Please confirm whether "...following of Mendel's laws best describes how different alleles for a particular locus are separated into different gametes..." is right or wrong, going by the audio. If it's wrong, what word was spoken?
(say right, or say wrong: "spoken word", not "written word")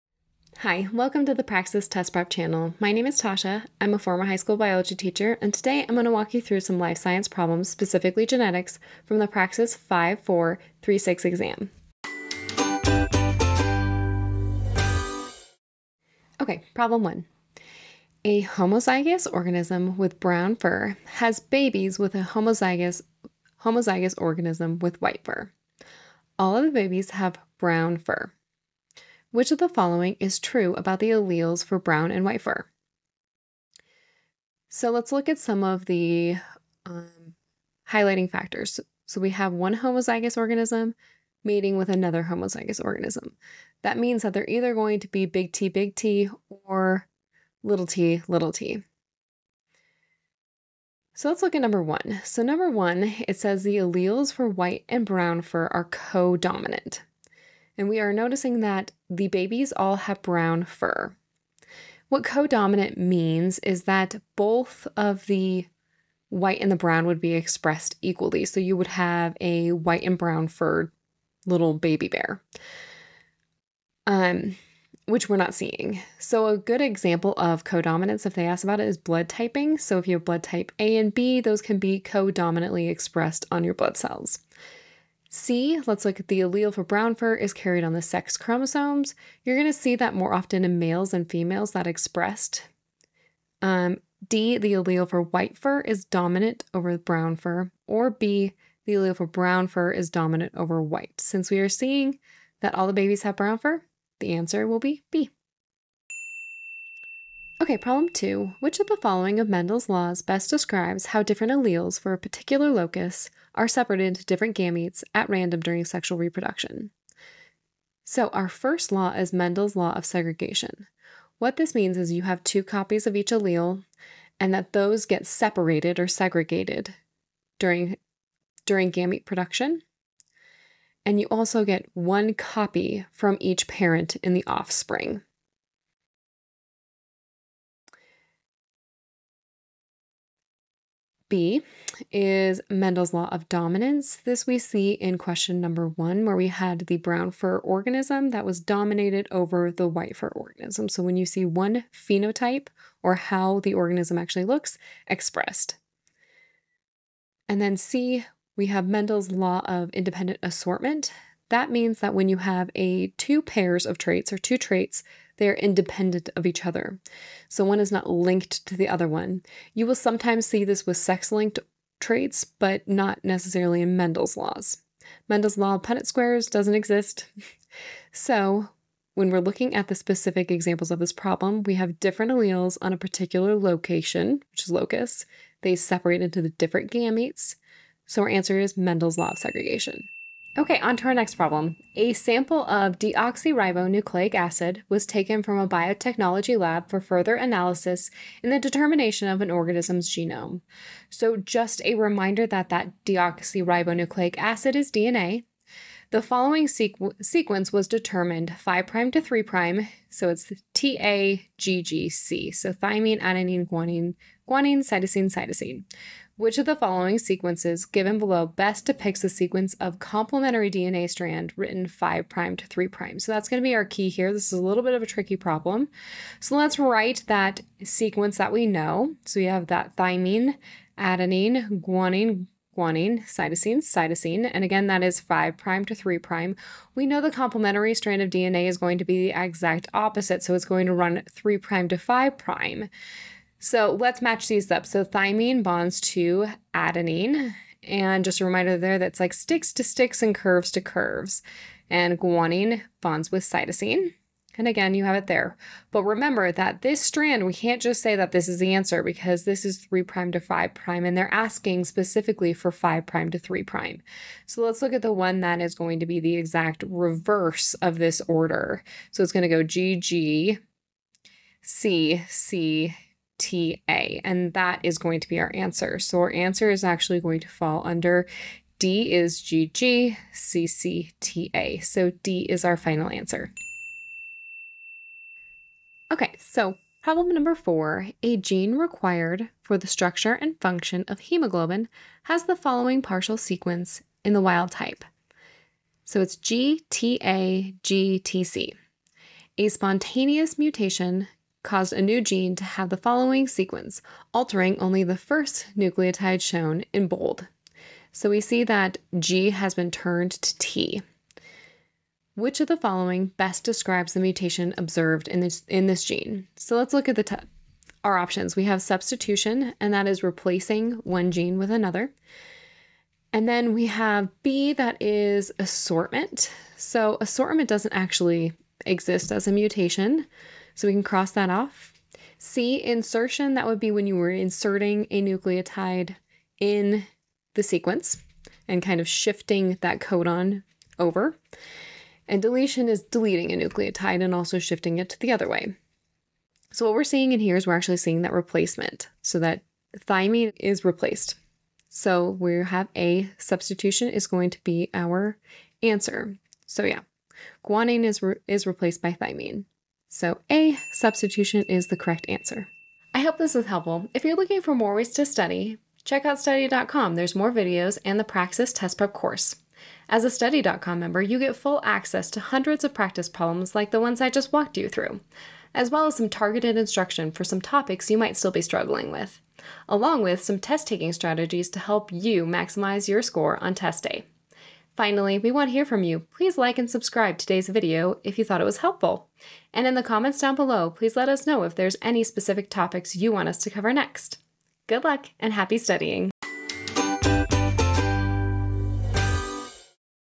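right.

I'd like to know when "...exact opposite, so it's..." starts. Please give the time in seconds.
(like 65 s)
239 s.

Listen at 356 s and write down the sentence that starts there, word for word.
So yeah, guanine is, re is replaced by thymine.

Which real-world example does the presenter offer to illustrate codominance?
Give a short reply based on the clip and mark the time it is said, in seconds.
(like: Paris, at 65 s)
blood typing, at 78 s.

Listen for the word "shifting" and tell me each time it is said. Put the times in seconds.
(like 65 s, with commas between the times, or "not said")
339 s, 344 s.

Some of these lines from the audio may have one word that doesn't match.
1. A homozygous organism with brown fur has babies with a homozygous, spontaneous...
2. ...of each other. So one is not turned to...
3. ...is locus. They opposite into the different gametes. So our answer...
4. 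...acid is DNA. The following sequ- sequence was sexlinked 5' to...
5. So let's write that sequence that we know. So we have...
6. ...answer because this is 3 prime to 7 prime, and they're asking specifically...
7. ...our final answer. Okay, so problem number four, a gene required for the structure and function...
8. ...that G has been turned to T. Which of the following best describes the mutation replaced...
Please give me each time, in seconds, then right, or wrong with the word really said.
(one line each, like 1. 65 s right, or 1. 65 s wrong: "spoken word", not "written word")
1. 18 s wrong: "homozygous", not "spontaneous"
2. 166 s wrong: "linked", not "turned"
3. 184 s wrong: "separate", not "opposite"
4. 204 s wrong: "determined", not "sexlinked"
5. 226 s right
6. 258 s wrong: "5", not "7"
7. 282 s right
8. 308 s wrong: "observed", not "replaced".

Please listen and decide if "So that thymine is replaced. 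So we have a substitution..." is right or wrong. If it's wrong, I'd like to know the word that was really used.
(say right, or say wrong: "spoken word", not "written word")
right.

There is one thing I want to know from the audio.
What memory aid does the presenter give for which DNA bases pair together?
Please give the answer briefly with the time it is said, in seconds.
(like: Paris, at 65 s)
sticks to sticks and curves to curves, at 249 s.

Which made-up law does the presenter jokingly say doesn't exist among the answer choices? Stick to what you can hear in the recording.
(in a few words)
Mendel's law of Punnett squares.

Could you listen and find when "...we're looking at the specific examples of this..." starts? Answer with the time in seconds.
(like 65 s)
179 s.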